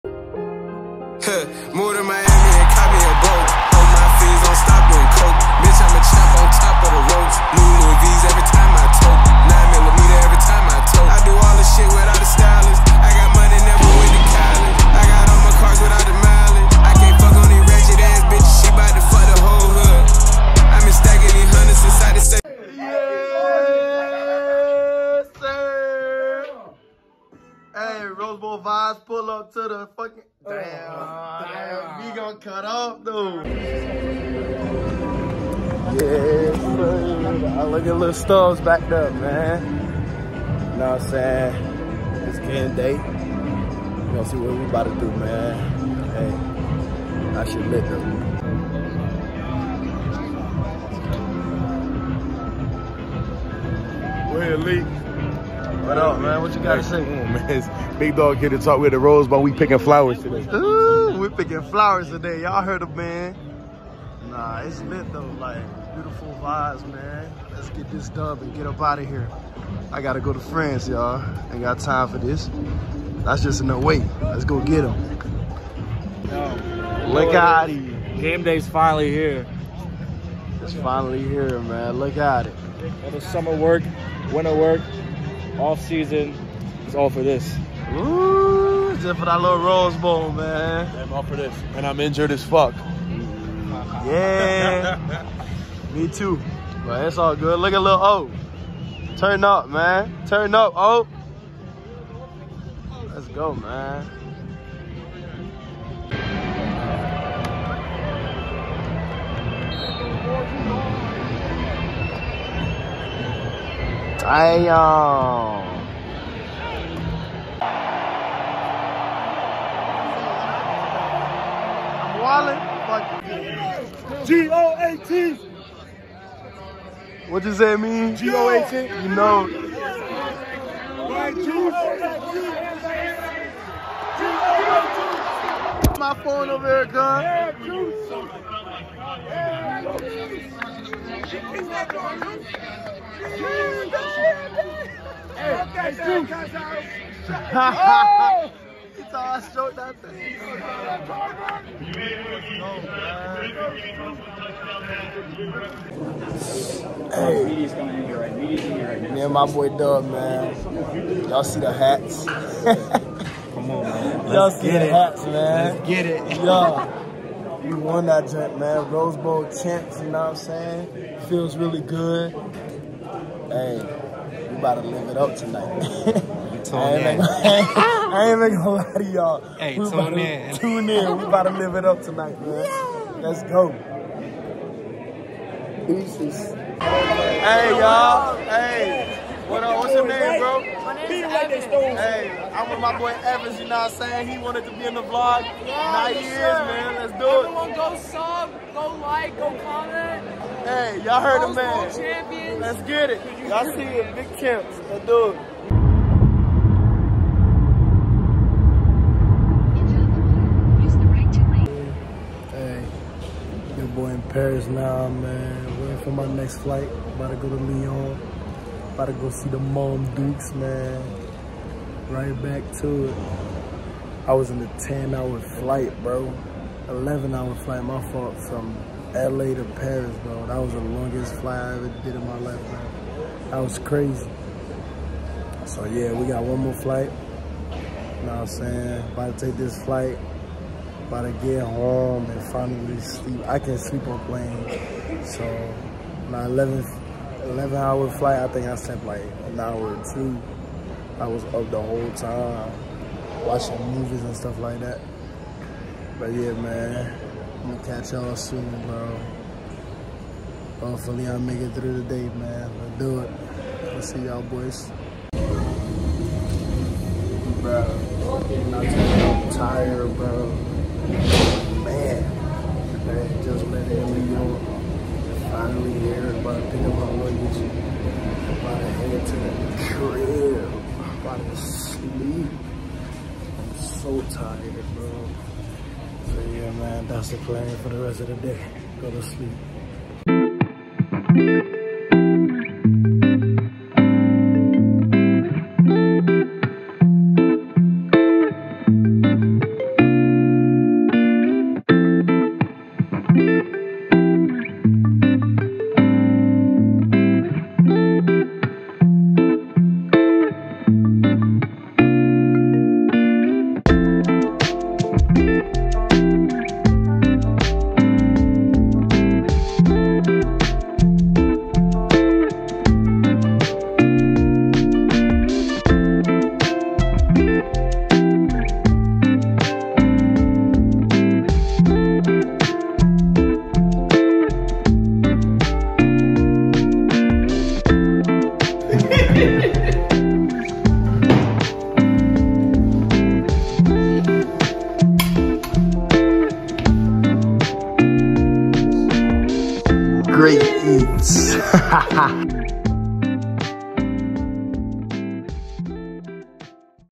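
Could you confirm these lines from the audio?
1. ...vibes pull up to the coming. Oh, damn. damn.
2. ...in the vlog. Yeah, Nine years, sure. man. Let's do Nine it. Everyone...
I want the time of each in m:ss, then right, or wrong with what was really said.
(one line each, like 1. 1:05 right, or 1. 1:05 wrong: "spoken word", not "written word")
1. 0:28 wrong: "fucking", not "coming"
2. 3:14 wrong: "Everyone", not "Nine".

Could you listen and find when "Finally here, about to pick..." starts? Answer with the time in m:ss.
4:35.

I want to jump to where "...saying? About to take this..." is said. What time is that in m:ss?
3:58.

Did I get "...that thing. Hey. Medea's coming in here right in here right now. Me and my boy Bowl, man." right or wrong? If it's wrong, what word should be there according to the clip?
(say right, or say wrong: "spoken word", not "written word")
wrong: "Dub", not "Bowl".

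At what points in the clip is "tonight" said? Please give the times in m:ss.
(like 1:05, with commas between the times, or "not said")
2:55, 3:02.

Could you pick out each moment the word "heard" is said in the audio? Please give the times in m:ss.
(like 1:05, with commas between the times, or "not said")
1:02, 3:21.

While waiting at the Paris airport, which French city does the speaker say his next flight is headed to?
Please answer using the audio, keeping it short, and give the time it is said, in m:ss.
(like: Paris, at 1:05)
Lyon, at 3:37.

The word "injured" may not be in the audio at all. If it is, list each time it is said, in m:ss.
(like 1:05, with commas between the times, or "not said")
1:31.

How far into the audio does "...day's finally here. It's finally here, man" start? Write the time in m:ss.
1:18.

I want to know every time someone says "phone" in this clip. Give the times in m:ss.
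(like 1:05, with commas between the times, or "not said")
2:16.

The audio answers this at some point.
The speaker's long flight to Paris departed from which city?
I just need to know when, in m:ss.
3:49.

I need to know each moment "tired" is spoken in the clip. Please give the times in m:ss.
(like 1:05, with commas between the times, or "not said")
4:29, 4:44.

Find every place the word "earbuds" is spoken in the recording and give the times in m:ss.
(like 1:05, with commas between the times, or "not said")
not said.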